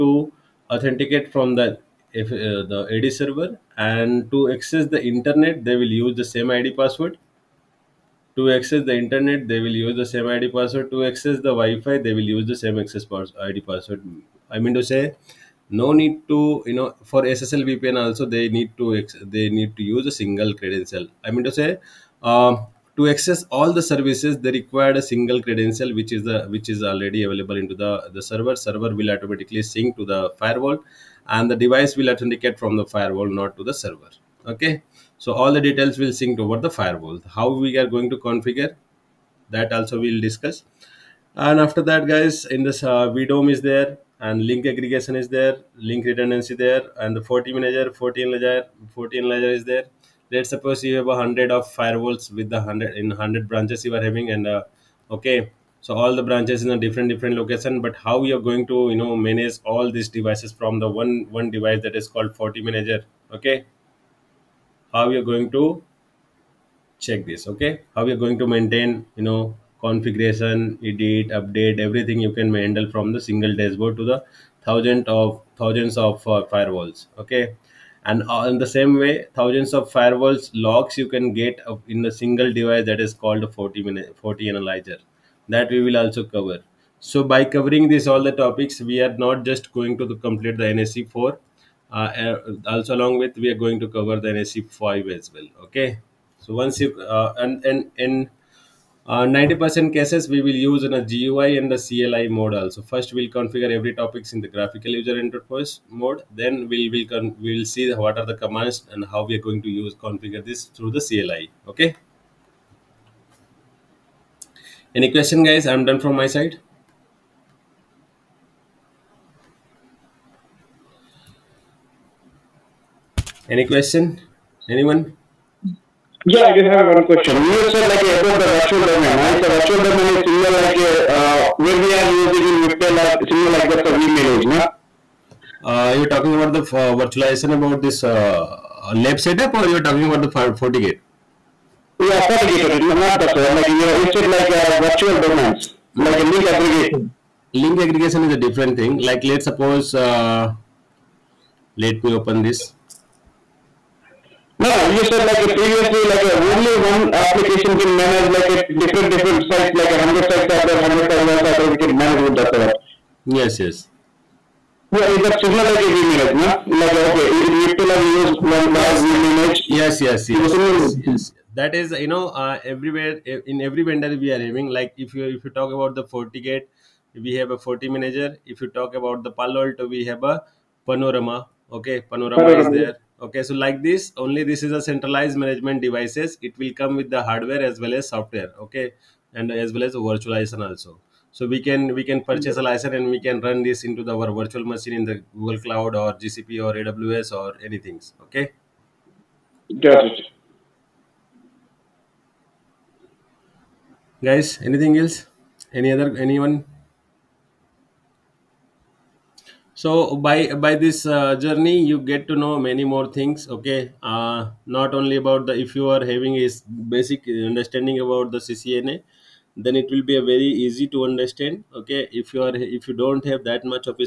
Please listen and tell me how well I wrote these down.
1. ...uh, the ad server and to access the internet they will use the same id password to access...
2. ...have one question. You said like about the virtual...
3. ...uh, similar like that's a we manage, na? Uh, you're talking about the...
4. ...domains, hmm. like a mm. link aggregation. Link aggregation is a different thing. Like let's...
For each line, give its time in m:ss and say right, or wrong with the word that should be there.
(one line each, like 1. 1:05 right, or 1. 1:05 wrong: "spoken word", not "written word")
1. 0:02 right
2. 2:06 right
3. 2:13 right
4. 2:25 right.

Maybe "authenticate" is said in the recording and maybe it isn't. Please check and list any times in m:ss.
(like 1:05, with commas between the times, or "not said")
0:00, 0:32.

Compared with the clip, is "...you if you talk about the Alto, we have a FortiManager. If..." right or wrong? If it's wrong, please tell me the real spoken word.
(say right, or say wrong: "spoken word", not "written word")
wrong: "FortiGate", not "Alto".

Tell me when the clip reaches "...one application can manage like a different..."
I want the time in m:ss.
2:36.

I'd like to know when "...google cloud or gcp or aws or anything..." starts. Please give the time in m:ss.
3:15.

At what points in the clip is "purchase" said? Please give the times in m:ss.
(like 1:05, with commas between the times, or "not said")
3:12.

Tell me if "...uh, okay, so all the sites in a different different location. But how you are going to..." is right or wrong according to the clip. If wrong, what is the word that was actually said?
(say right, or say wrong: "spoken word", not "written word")
wrong: "branches", not "sites".